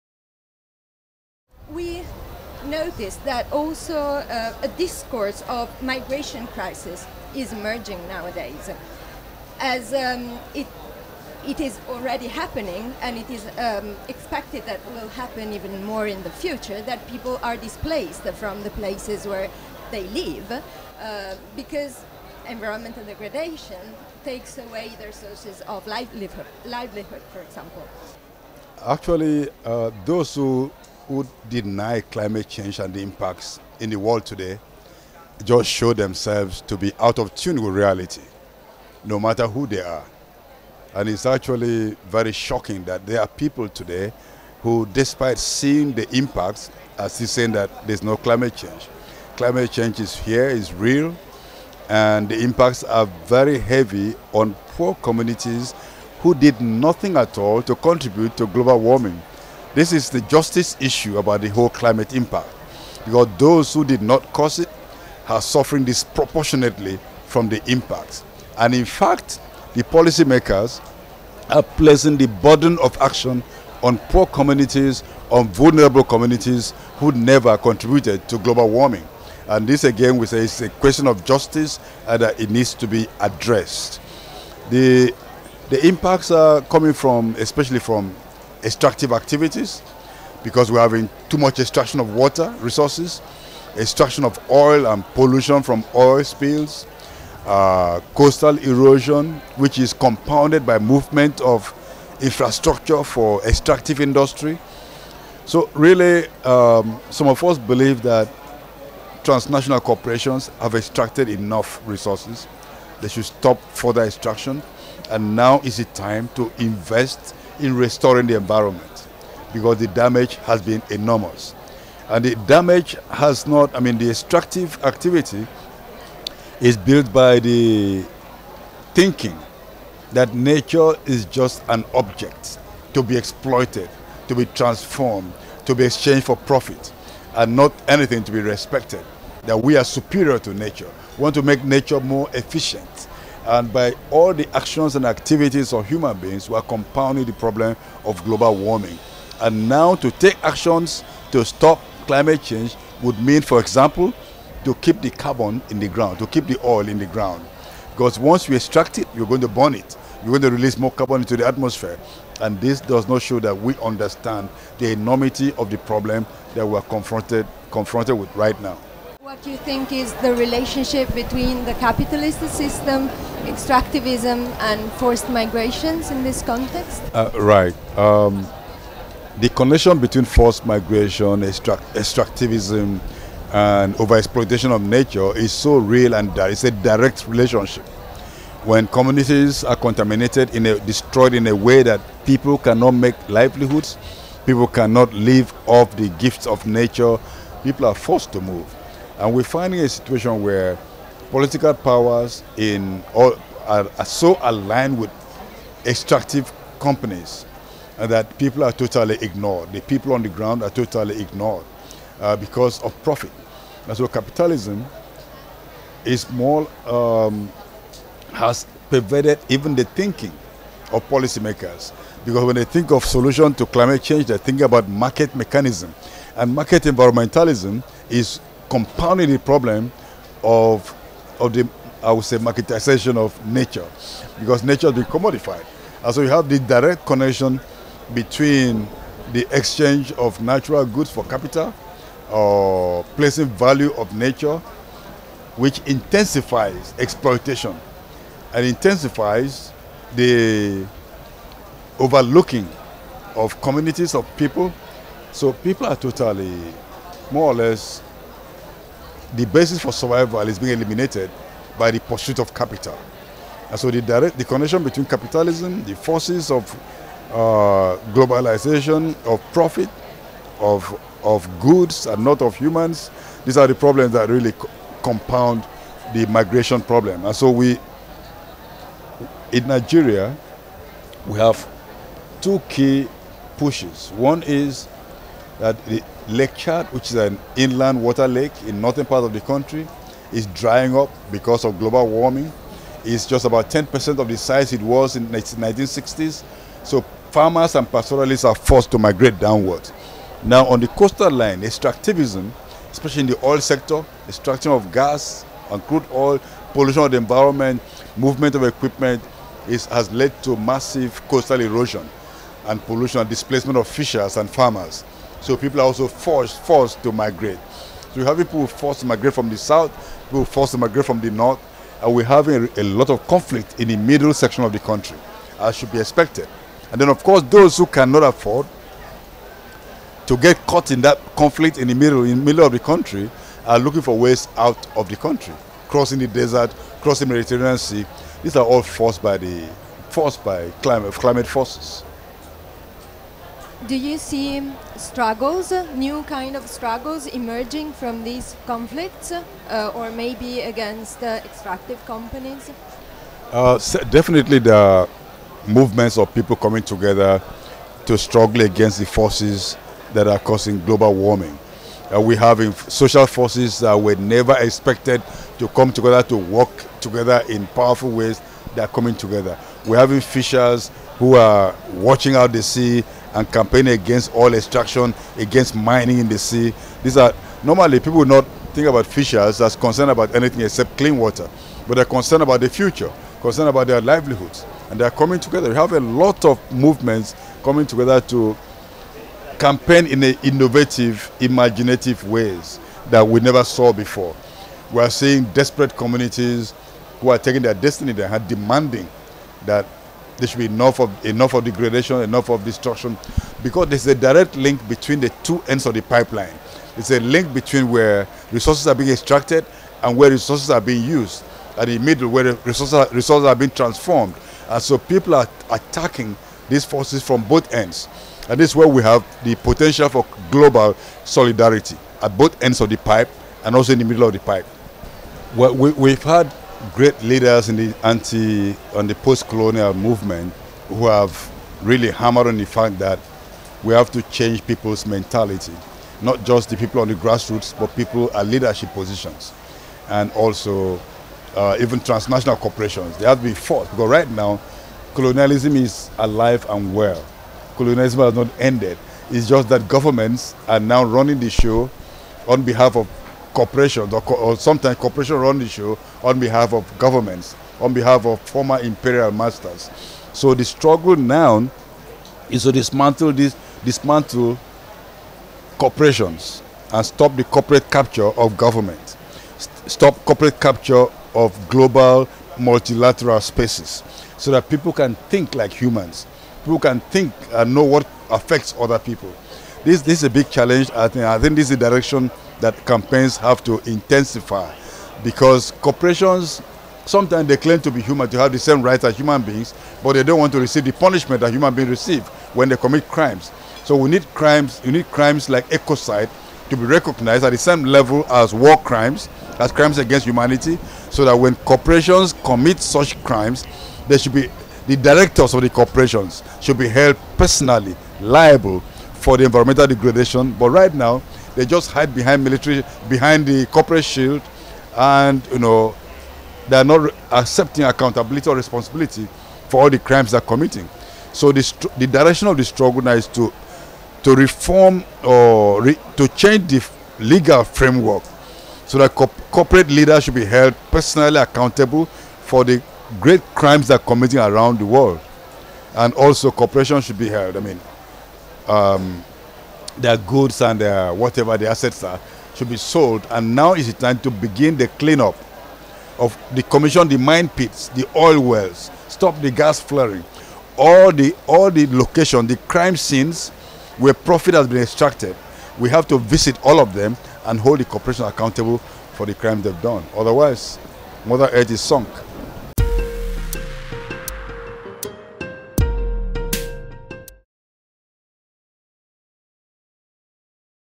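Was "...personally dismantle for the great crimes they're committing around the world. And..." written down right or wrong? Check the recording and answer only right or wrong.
wrong.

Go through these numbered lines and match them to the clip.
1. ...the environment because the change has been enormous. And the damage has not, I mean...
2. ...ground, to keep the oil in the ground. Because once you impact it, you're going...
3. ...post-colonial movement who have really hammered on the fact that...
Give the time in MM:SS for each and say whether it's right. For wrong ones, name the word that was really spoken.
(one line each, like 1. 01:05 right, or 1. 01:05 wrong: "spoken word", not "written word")
1. 01:58 wrong: "damage", not "change"
2. 02:35 wrong: "extract", not "impact"
3. 07:09 right.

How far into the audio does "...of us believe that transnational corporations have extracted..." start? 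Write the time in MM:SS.
01:47.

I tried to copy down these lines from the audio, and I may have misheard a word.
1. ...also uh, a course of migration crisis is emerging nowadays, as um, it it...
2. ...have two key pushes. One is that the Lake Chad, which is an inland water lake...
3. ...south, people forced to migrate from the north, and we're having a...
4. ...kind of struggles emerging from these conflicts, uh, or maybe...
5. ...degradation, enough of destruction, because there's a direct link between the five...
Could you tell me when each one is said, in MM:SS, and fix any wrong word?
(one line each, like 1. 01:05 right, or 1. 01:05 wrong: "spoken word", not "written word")
1. 00:03 wrong: "discourse", not "course"
2. 04:41 right
3. 05:19 right
4. 05:46 right
5. 06:41 wrong: "two", not "five".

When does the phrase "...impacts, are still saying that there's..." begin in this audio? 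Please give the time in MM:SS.
00:46.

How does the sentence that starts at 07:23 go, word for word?
They have to be fought because right now, colonialism is alive and well.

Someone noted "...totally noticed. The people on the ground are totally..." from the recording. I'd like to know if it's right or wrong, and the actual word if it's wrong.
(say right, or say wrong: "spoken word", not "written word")
wrong: "ignored", not "noticed".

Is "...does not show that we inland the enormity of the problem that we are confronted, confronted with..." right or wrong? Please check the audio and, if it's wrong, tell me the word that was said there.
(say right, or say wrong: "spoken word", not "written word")
wrong: "understand", not "inland".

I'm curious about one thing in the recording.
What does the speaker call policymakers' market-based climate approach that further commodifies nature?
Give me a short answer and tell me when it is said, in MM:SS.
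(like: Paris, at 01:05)
market environmentalism, at 03:46.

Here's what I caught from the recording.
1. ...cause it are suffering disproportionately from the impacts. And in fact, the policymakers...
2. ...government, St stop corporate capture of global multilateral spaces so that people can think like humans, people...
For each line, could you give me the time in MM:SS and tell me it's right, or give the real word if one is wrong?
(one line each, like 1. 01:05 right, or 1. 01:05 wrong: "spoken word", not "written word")
1. 01:04 right
2. 07:48 right.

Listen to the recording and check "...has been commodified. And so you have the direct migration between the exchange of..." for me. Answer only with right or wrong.
wrong.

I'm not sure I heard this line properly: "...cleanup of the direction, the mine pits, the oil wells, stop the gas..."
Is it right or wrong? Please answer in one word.
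wrong.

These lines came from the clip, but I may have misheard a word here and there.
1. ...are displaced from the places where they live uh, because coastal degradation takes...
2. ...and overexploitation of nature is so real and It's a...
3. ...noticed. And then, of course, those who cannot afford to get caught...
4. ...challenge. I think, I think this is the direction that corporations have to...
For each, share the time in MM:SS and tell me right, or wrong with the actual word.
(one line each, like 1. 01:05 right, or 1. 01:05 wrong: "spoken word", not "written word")
1. 00:17 wrong: "environmental", not "coastal"
2. 03:03 right
3. 05:25 wrong: "expected", not "noticed"
4. 08:00 wrong: "campaigns", not "corporations".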